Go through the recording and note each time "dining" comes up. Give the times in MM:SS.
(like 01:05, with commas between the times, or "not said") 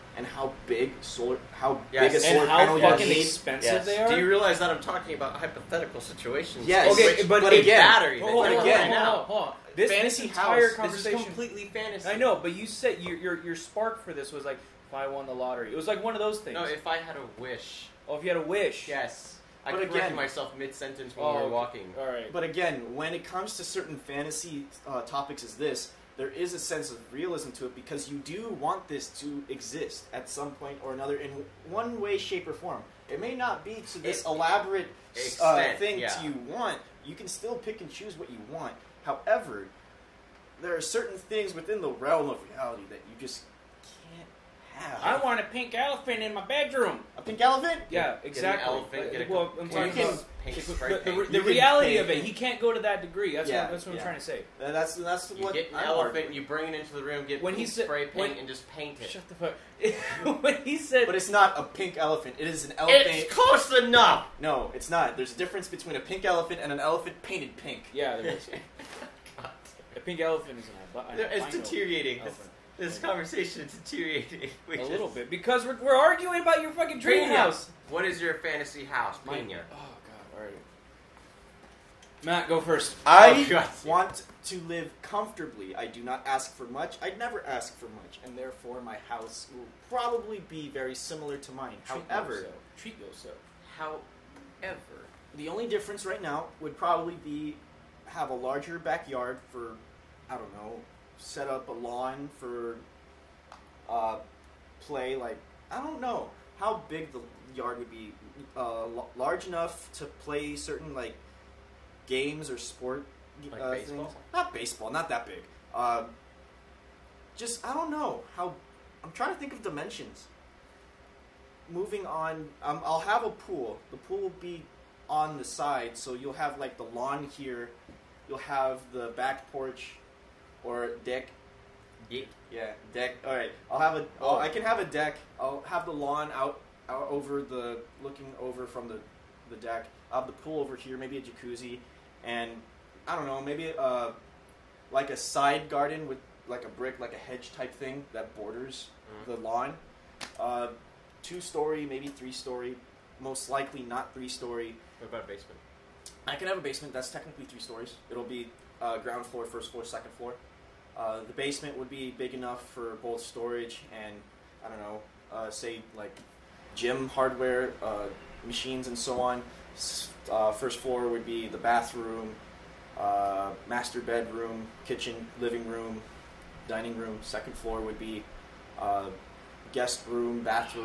02:56.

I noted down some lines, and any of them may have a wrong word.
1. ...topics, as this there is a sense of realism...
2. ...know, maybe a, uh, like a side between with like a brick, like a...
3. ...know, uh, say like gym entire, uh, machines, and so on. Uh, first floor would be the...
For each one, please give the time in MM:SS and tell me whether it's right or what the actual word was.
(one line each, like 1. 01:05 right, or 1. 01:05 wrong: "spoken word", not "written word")
1. 00:25 right
2. 02:23 wrong: "garden", not "between"
3. 02:44 wrong: "hardware", not "entire".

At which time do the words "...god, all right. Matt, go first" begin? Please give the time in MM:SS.
01:19.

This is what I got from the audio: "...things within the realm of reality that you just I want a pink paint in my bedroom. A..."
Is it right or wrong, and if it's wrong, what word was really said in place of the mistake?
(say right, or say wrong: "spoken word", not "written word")
wrong: "elephant", not "paint".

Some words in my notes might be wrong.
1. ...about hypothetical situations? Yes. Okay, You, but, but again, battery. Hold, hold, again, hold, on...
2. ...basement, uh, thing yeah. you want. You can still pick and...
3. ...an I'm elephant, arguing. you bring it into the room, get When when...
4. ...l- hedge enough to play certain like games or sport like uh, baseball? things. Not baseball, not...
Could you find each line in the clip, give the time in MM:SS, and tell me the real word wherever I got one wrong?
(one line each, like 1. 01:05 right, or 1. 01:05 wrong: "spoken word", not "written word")
1. 00:05 wrong: "Which", not "You"
2. 00:35 wrong: "extent", not "basement"
3. 00:55 right
4. 01:48 wrong: "large", not "hedge".